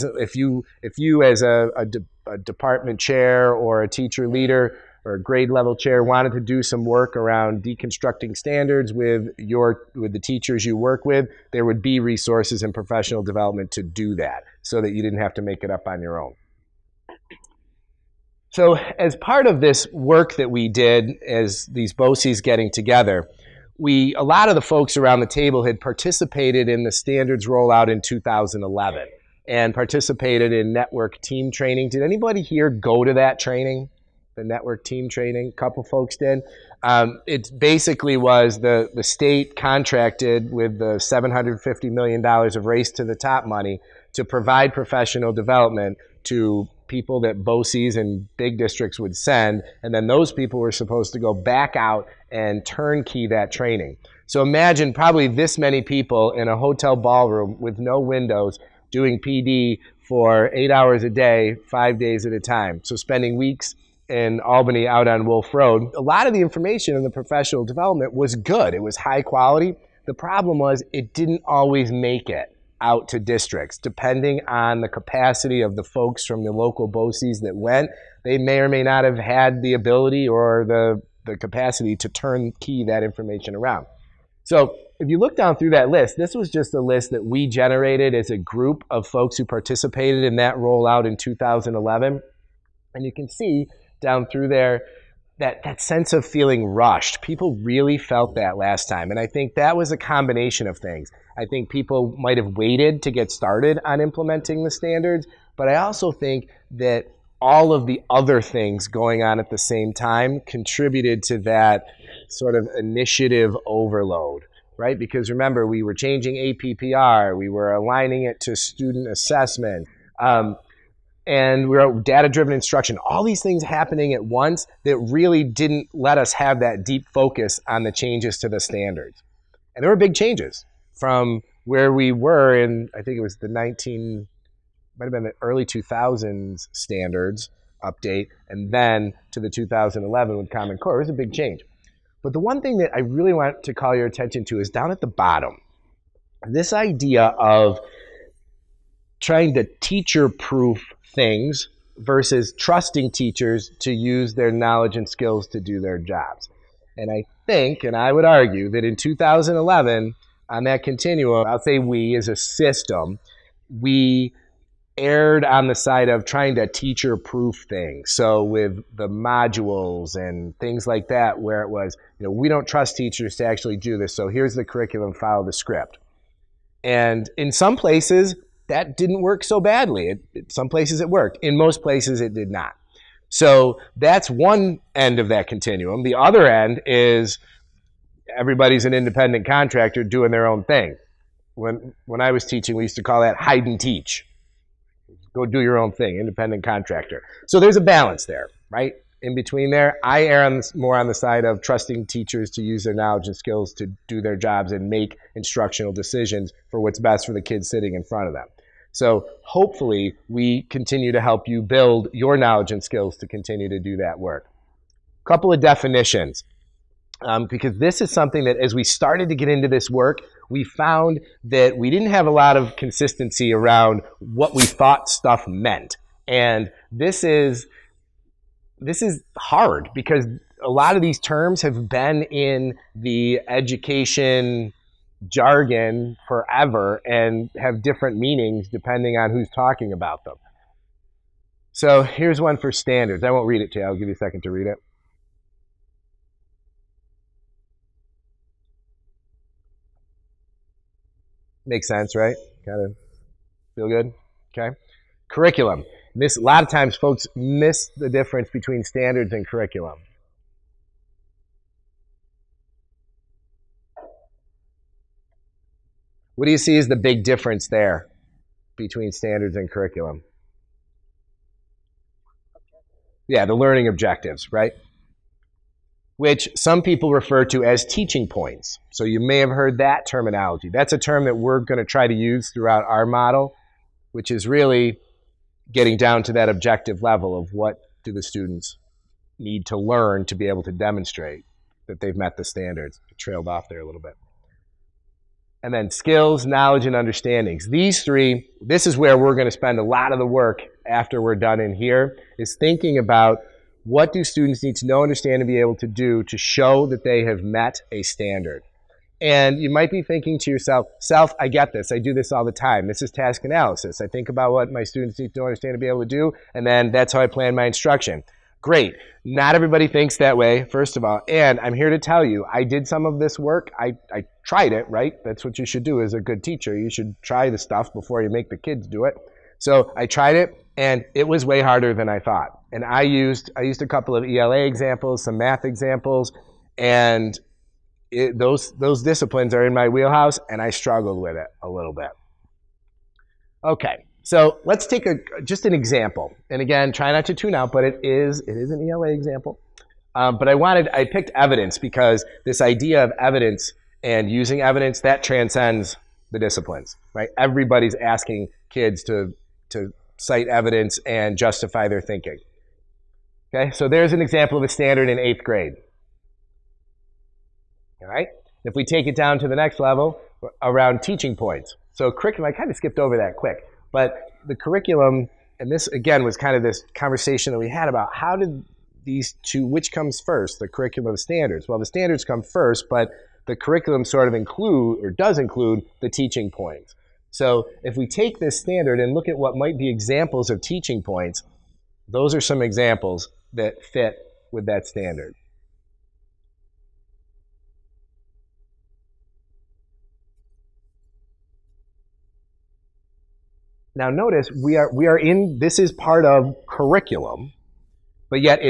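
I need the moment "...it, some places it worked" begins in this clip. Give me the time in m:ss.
3:00.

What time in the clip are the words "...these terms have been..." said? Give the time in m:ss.
3:51.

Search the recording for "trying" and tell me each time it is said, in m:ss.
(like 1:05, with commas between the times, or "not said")
2:29, 2:46.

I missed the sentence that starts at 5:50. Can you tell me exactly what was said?
Um, but I wanted I picked evidence because this idea of evidence and using evidence that transcends the disciplines, right?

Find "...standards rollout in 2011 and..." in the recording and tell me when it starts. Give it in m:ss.
0:26.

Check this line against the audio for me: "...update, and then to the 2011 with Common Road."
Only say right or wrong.
wrong.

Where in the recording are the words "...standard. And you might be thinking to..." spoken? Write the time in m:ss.
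5:08.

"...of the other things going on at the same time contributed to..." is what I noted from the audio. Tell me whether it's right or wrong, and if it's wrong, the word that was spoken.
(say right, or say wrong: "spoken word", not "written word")
right.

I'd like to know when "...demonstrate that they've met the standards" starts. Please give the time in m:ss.
4:50.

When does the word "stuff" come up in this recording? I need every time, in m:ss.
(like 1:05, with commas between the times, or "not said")
3:45, 5:27.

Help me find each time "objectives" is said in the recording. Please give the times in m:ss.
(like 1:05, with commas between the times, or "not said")
4:33, 4:46.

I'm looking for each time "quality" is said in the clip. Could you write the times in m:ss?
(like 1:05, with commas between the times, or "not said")
1:09.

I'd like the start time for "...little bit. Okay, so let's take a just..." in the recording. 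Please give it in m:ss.
5:41.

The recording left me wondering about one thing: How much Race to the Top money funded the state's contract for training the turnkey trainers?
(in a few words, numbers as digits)
$750 million.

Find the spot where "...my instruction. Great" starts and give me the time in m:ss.
5:17.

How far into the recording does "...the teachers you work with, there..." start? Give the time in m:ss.
0:10.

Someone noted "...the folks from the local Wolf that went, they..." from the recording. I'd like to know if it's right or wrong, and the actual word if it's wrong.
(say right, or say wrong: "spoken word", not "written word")
wrong: "BOCES", not "Wolf".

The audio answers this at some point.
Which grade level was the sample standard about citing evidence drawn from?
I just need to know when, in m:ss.
6:05.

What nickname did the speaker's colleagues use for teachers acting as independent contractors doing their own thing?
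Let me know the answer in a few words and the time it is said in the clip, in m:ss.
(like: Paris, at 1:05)
hide and teach, at 3:13.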